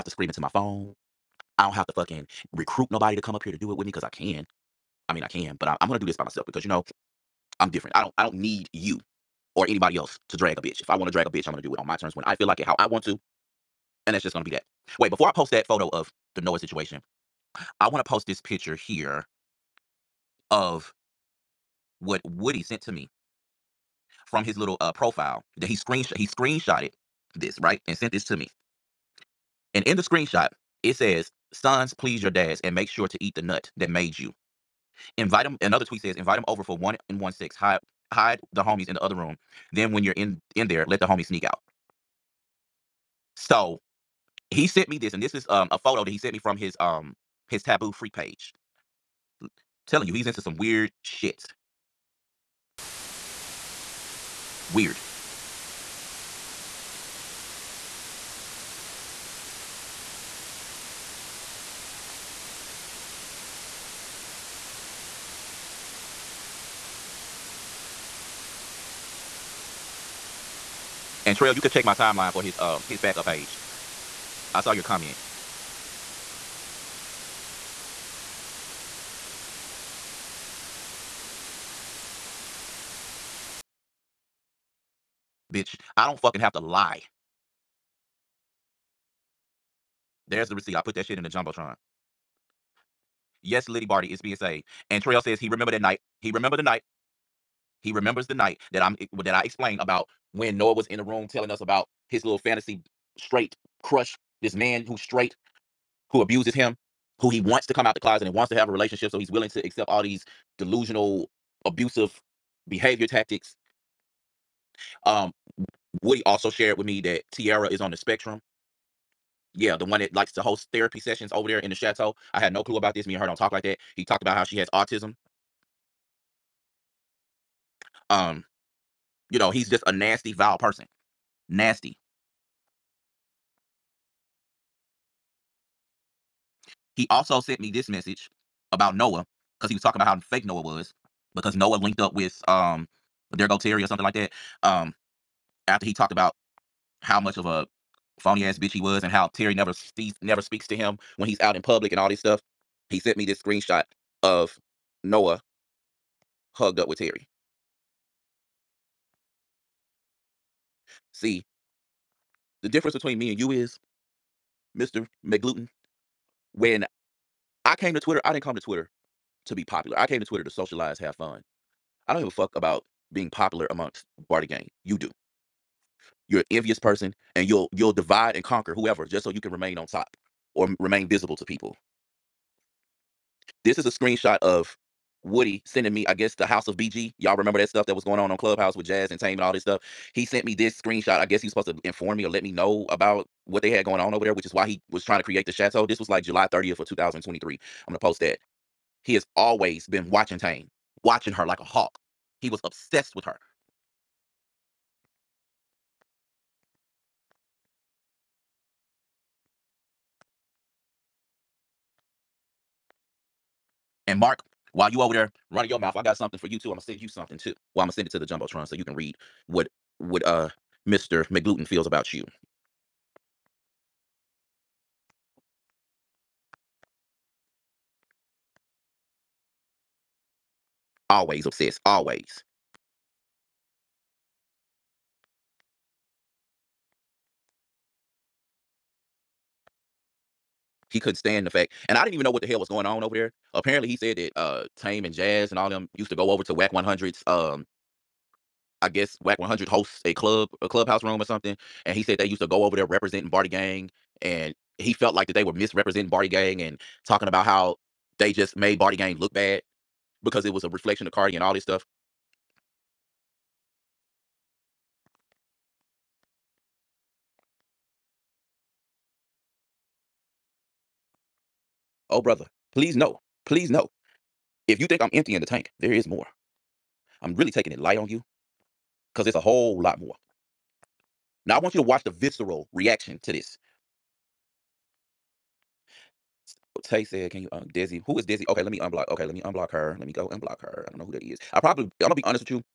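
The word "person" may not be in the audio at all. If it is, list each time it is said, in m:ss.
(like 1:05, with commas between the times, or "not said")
2:10, 2:56.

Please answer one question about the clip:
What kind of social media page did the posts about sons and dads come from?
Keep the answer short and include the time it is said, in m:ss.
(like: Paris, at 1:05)
taboo freak page, at 0:47.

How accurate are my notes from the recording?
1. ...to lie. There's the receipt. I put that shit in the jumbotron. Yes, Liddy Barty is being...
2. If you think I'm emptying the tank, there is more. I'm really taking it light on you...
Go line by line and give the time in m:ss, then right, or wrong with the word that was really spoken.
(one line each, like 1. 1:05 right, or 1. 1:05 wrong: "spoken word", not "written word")
1. 1:26 right
2. 4:34 right.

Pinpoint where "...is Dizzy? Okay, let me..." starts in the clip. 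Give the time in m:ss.
4:48.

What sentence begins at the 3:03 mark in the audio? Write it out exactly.
This is a screenshot of Woody sending me, I guess, the House of BG.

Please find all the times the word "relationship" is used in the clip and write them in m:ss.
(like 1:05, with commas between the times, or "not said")
1:48.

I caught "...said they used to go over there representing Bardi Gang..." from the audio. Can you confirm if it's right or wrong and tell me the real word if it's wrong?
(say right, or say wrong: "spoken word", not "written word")
right.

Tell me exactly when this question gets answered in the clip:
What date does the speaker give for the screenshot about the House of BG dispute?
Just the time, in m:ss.
3:16.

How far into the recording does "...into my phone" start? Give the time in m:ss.
0:00.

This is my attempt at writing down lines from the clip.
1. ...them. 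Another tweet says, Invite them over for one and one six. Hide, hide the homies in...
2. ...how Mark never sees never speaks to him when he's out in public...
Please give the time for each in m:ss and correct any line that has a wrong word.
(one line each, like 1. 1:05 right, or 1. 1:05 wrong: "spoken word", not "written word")
1. 0:35 right
2. 2:29 wrong: "Terry", not "Mark".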